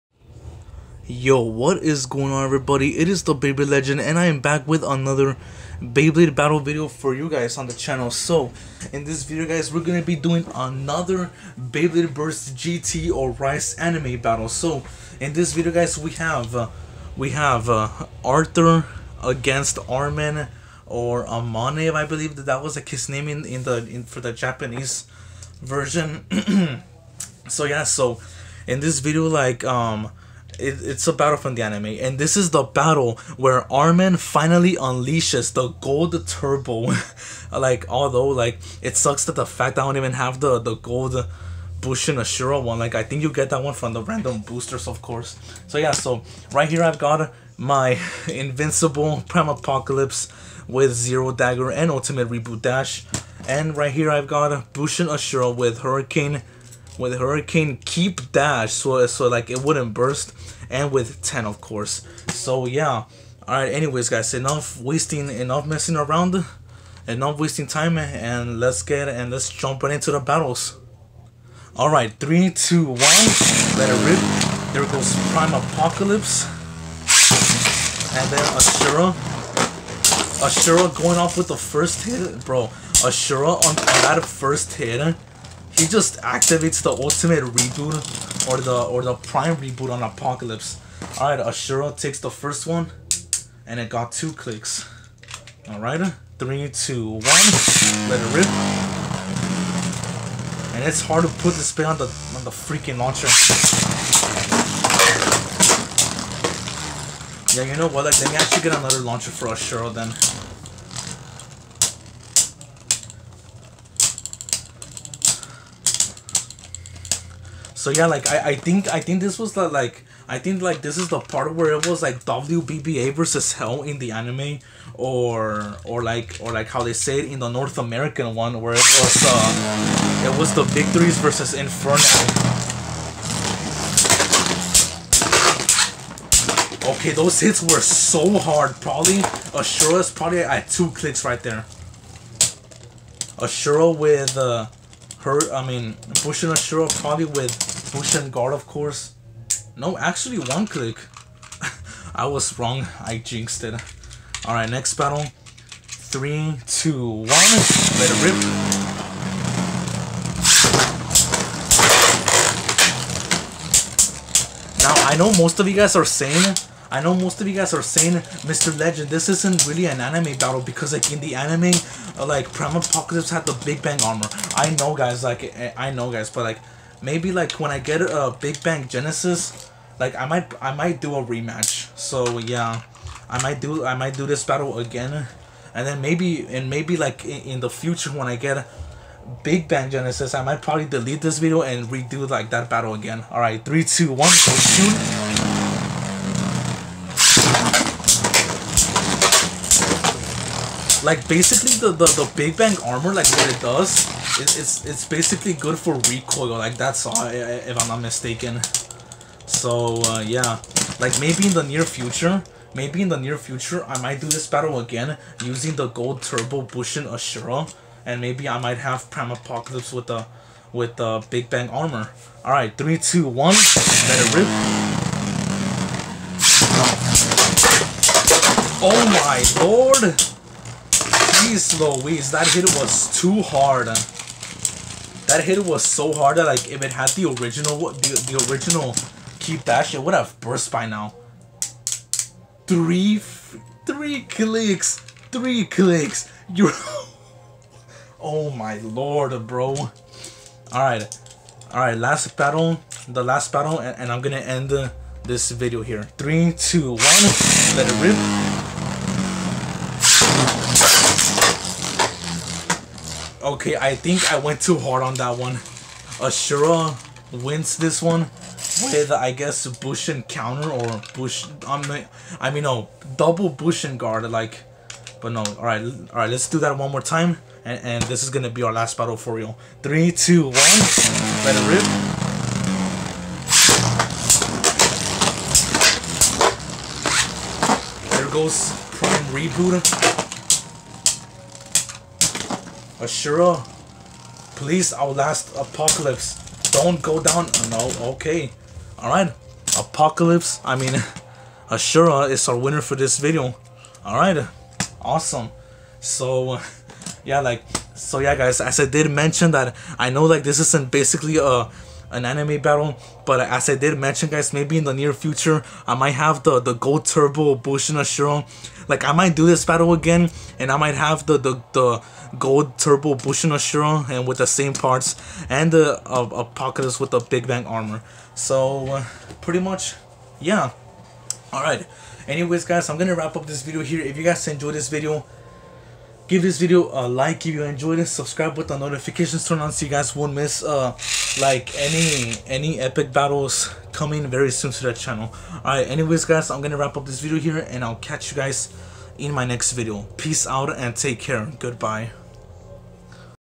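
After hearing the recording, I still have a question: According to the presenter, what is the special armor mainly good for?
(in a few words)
Recoil.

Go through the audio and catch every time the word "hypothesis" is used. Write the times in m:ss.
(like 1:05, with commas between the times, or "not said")
not said.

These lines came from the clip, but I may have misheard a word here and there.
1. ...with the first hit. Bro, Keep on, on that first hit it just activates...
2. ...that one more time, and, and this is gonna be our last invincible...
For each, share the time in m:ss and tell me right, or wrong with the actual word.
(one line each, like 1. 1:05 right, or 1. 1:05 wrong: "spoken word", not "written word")
1. 1:21 wrong: "Ashura", not "Keep"
2. 4:36 wrong: "battle", not "invincible".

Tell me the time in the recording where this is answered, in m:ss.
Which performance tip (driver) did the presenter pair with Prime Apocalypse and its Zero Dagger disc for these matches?
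0:51.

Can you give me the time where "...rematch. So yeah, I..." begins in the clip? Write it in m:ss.
3:01.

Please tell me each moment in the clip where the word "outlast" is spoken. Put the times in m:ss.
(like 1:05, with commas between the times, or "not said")
4:54.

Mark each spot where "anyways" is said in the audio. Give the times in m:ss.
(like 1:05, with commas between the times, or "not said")
1:03, 5:32, 5:45.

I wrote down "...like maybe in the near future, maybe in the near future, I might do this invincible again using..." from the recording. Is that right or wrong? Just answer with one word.
wrong.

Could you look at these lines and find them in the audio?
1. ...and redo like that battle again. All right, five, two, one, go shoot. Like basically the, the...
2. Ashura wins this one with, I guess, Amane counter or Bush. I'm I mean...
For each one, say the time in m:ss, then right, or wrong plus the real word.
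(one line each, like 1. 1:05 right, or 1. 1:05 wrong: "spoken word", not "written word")
1. 3:11 wrong: "three", not "five"
2. 4:26 wrong: "Bushin", not "Amane".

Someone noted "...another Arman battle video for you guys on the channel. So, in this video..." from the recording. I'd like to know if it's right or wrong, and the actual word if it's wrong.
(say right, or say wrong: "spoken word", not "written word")
wrong: "Beyblade", not "Arman".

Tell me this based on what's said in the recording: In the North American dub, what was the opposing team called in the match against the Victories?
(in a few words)
Inferno.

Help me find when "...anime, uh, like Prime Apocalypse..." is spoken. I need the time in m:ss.
2:51.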